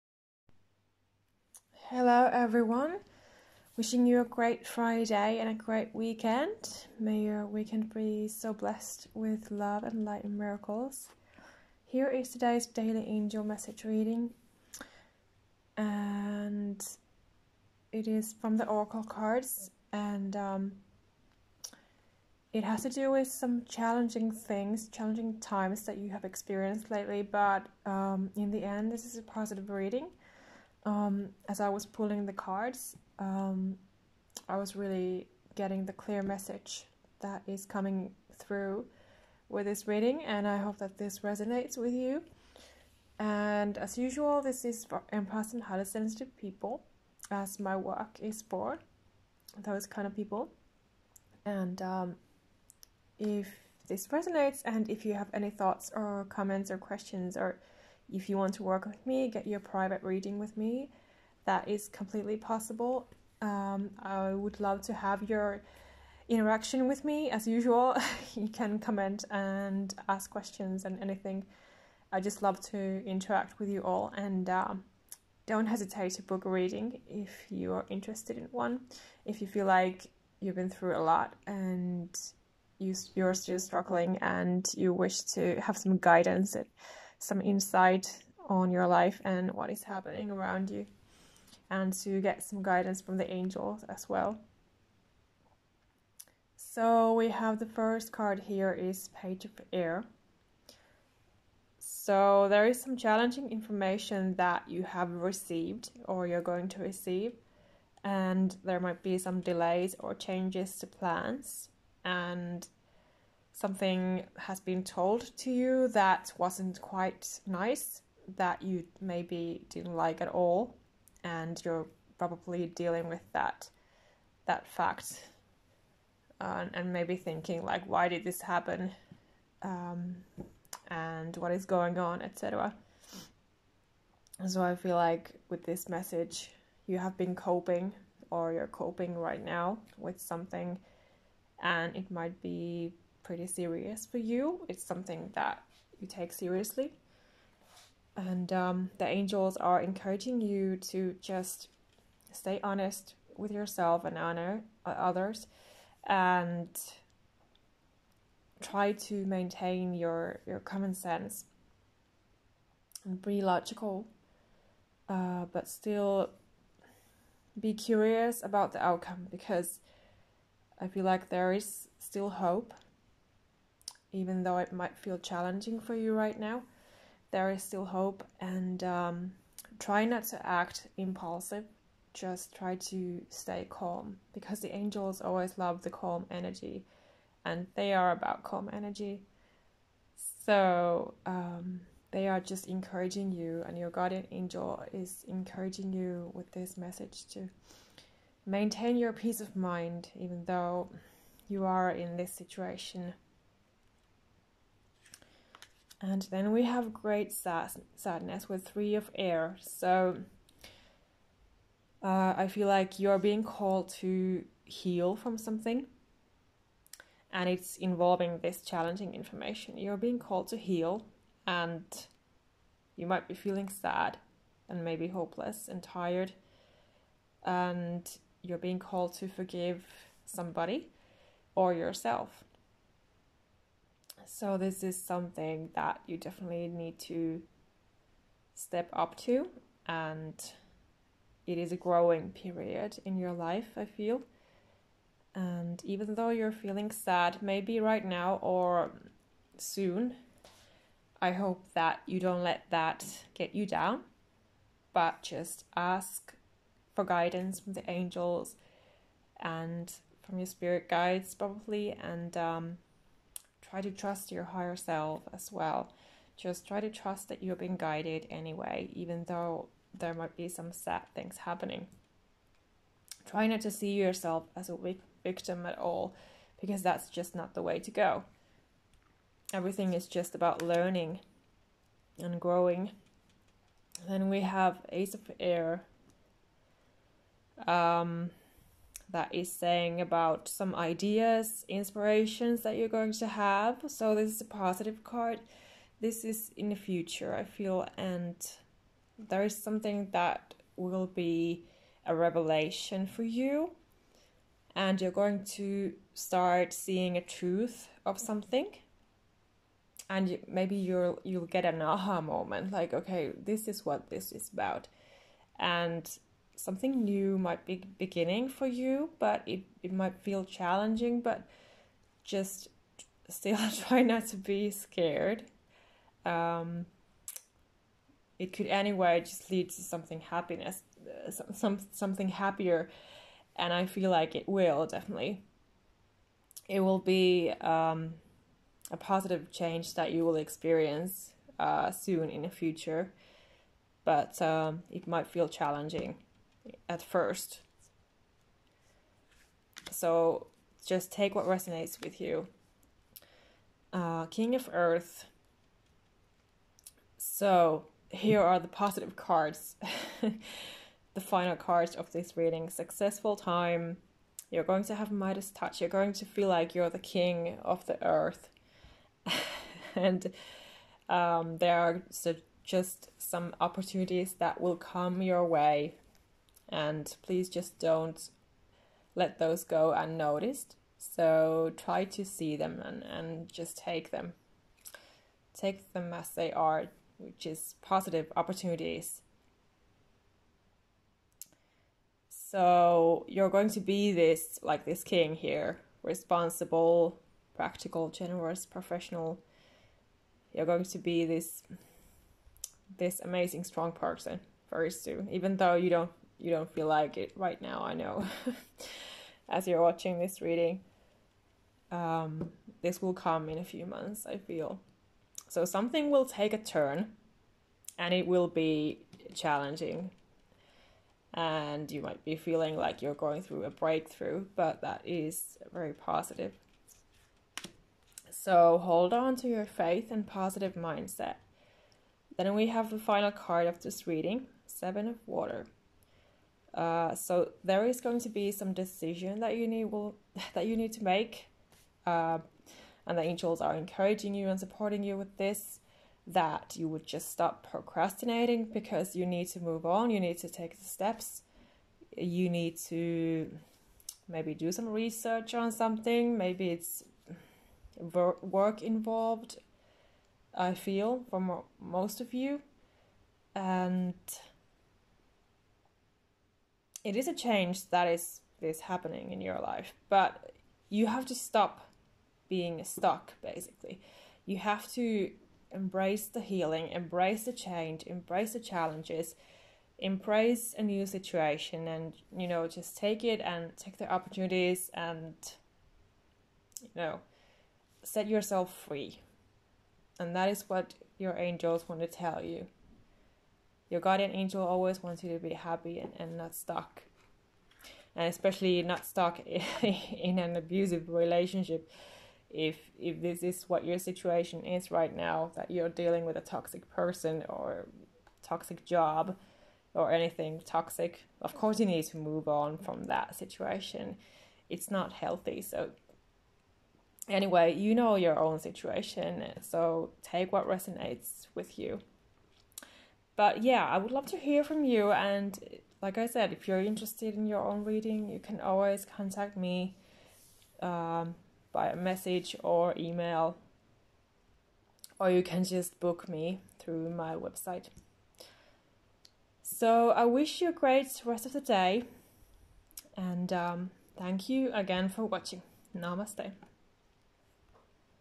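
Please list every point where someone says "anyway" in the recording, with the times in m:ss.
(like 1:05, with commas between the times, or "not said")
4:28, 5:28, 8:37.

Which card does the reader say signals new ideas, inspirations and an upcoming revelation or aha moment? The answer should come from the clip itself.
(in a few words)
Ace of Air.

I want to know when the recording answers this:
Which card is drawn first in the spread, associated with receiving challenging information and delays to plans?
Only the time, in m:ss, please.
1:39.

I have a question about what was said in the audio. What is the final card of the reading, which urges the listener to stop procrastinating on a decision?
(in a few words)
Seven of Water.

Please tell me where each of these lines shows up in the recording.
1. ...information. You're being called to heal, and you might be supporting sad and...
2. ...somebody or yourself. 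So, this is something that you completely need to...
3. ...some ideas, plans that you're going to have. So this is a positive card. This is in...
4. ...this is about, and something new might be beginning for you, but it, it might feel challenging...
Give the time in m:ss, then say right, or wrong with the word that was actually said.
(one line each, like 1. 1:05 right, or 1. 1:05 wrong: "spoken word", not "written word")
1. 3:39 wrong: "feeling", not "supporting"
2. 3:50 wrong: "definitely", not "completely"
3. 4:50 wrong: "inspirations", not "plans"
4. 5:14 right.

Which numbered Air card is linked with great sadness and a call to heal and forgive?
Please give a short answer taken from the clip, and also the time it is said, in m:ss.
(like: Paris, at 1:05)
Three of Air, at 3:28.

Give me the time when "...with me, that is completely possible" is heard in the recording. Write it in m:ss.
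1:00.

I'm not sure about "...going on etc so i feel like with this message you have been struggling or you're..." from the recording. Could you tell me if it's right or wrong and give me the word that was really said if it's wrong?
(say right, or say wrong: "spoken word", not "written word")
wrong: "coping", not "struggling".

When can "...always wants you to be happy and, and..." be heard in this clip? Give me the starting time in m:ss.
8:14.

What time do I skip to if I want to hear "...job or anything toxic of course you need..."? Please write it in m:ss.
8:28.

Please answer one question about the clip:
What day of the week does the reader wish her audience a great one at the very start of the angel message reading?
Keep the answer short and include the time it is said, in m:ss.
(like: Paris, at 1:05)
Friday, at 0:04.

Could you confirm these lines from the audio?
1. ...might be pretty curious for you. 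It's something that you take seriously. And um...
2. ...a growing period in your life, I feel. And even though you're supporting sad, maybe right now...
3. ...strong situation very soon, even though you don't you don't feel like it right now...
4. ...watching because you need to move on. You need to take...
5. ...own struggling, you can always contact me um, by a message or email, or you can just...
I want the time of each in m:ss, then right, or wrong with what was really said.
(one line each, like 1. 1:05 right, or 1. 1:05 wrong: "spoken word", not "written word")
1. 2:22 wrong: "serious", not "curious"
2. 4:01 wrong: "feeling", not "supporting"
3. 6:43 wrong: "person", not "situation"
4. 7:27 wrong: "procrastinating", not "watching"
5. 8:47 wrong: "reading", not "struggling".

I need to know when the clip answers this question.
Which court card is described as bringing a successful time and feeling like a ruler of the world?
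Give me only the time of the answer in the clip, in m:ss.
5:54.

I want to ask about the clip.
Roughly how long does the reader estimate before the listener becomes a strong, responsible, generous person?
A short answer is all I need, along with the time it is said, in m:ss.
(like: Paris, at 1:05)
a few months, at 6:53.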